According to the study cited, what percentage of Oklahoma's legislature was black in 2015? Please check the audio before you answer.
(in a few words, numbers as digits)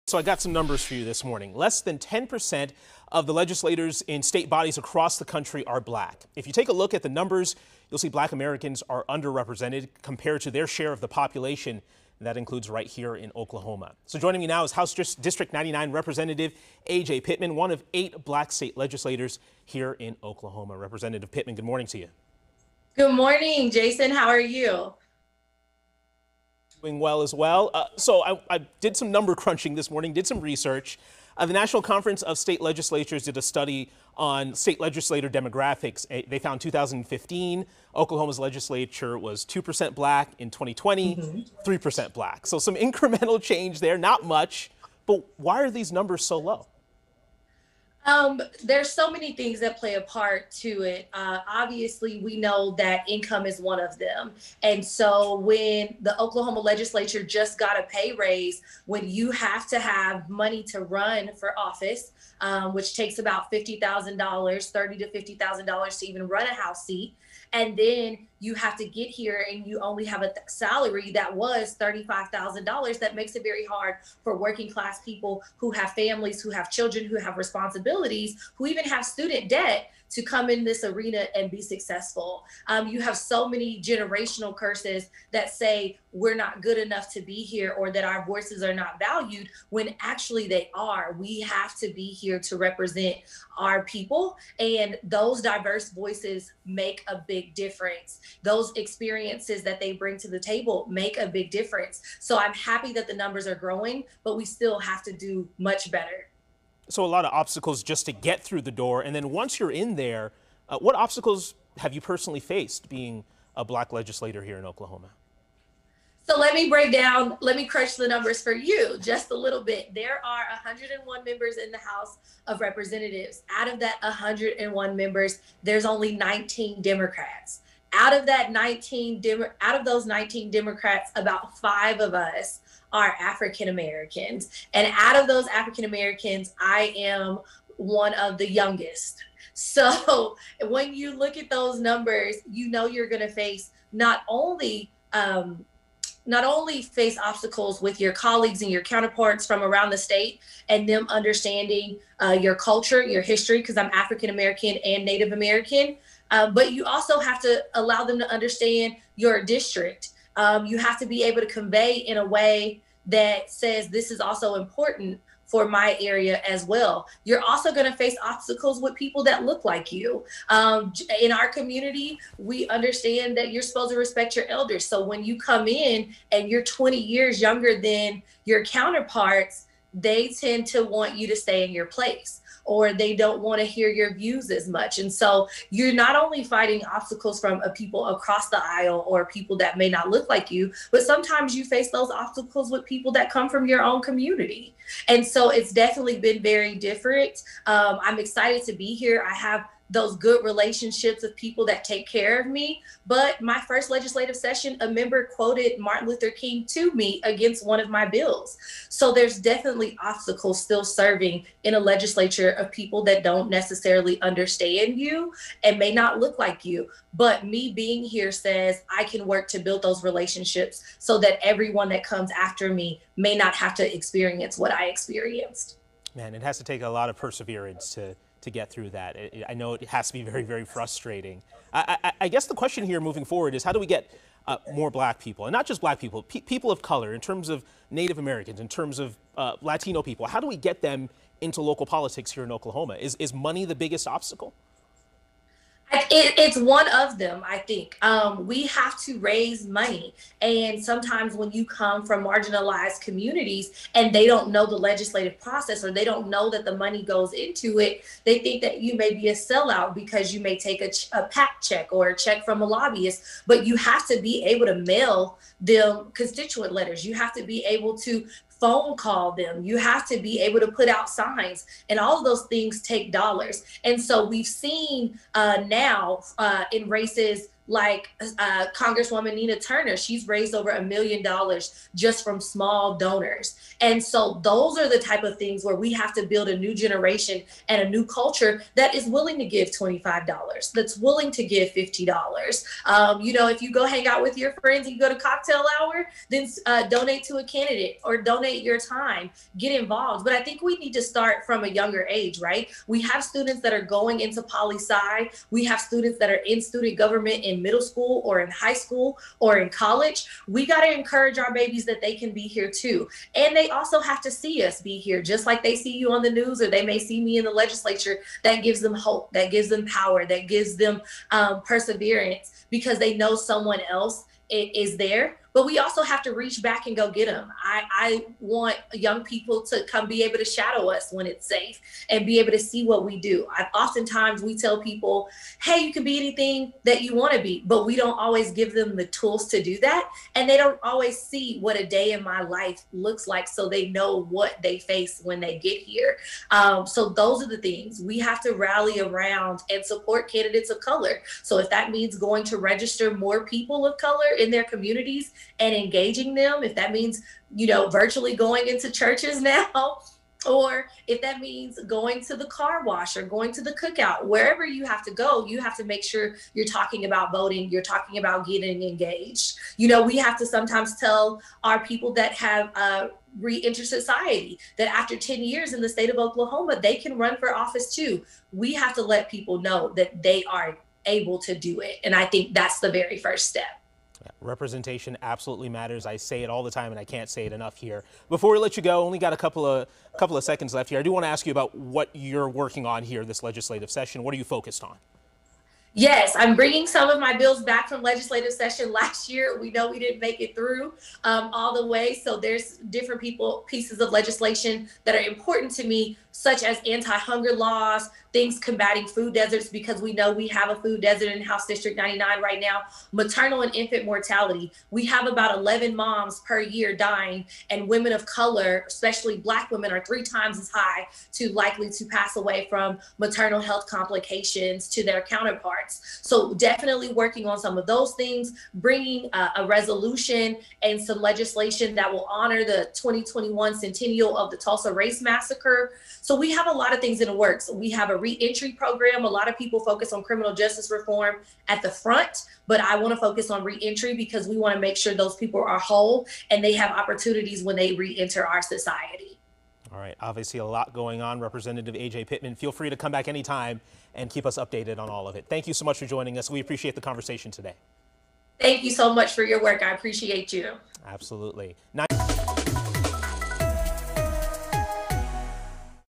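2%.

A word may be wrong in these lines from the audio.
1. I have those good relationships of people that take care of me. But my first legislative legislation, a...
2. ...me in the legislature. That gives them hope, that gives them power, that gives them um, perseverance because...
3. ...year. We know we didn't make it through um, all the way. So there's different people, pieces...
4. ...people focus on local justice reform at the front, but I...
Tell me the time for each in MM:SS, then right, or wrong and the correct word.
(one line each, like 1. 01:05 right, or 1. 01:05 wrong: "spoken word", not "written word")
1. 03:19 wrong: "session", not "legislation"
2. 05:17 right
3. 06:39 right
4. 07:19 wrong: "criminal", not "local".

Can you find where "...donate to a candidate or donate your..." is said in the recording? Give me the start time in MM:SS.
04:56.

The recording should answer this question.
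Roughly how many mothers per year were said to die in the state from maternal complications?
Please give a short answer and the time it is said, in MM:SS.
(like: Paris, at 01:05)
11, at 06:55.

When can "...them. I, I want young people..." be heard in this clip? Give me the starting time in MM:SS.
05:27.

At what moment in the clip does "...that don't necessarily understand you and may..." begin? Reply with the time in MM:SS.
03:33.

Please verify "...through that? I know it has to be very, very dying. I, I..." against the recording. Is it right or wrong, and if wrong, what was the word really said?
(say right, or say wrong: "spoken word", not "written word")
wrong: "frustrating", not "dying".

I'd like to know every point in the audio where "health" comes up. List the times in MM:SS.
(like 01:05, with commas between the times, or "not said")
07:03.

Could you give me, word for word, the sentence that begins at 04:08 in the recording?
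Um, we have to raise money.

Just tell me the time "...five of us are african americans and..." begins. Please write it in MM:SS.
02:11.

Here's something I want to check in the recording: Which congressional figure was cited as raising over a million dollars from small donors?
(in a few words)
Nina Turner.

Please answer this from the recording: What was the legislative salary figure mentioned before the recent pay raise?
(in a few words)
$35,000.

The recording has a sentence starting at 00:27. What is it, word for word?
Uh, so I, I, did some number crunching this morning, did some research.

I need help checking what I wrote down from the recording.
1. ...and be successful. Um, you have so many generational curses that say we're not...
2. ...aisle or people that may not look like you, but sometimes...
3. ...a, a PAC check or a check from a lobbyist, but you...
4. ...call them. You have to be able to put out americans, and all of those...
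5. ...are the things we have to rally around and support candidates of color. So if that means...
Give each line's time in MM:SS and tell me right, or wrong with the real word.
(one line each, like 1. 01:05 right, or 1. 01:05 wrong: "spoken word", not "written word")
1. 01:21 right
2. 03:08 right
3. 04:20 right
4. 04:28 wrong: "signs", not "americans"
5. 05:47 right.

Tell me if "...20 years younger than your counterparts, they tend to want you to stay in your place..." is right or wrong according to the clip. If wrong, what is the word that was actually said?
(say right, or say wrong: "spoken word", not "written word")
right.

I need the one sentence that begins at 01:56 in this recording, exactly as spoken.
So let me break down, let me crunch the numbers for you just a little bit.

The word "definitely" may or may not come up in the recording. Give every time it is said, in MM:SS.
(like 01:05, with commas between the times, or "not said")
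03:15, 03:29, 07:06.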